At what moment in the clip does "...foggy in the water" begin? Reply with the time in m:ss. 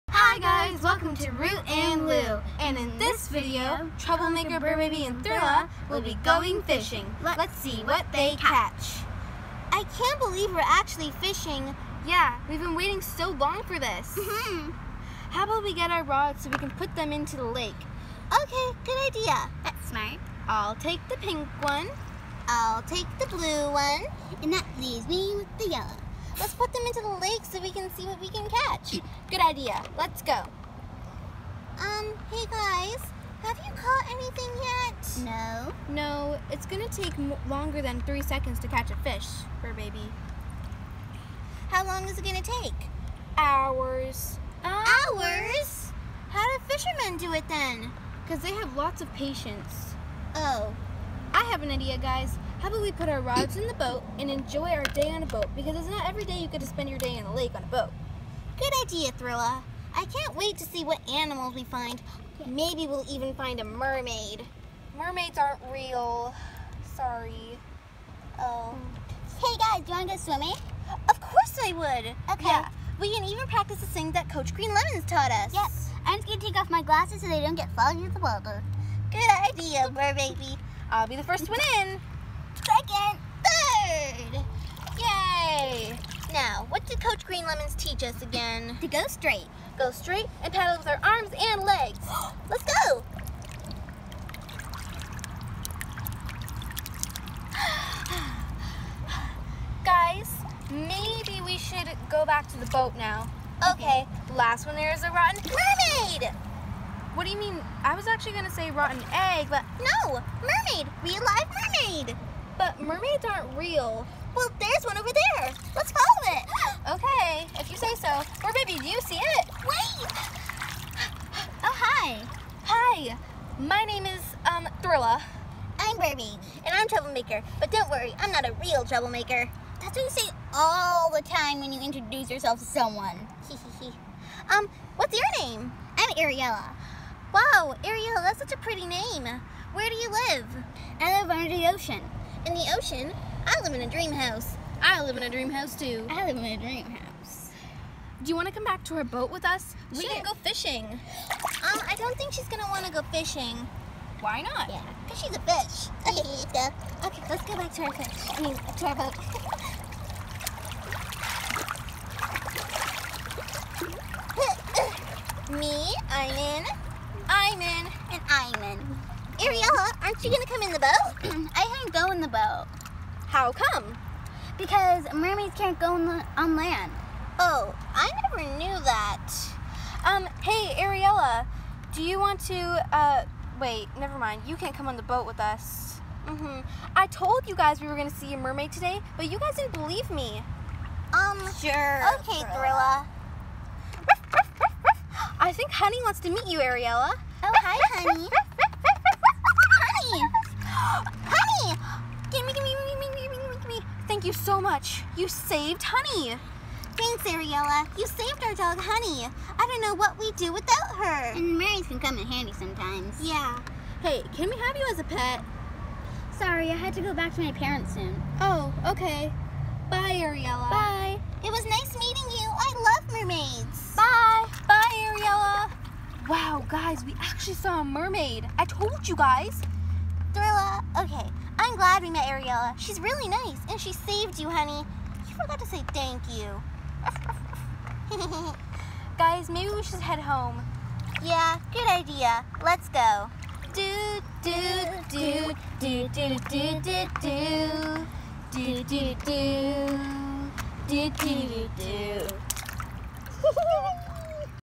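1:17.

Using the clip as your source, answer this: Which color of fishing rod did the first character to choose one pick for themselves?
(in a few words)
Pink.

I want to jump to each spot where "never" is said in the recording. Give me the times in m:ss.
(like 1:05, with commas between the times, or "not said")
2:58, 3:03.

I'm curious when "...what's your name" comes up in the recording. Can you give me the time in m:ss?
2:14.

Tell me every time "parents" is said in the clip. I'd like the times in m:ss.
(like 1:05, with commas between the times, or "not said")
3:37.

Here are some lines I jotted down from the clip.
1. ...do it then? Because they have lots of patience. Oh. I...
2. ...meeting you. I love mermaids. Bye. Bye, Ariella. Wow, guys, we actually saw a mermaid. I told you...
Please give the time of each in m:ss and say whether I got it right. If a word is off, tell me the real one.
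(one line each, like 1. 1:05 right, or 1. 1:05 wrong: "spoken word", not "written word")
1. 0:47 right
2. 3:41 right.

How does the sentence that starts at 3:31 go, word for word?
And Marys can come in handy sometimes.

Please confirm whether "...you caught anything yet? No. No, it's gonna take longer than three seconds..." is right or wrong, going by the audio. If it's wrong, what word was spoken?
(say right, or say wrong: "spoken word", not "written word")
right.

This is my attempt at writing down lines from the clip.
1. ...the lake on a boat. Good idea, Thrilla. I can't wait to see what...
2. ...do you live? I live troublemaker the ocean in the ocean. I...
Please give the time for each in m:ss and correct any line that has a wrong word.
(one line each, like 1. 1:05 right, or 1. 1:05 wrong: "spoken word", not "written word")
1. 0:57 right
2. 2:19 wrong: "under", not "troublemaker".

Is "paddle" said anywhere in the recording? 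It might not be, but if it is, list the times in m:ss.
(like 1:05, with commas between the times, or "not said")
1:30.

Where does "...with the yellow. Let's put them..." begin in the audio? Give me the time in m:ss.
0:25.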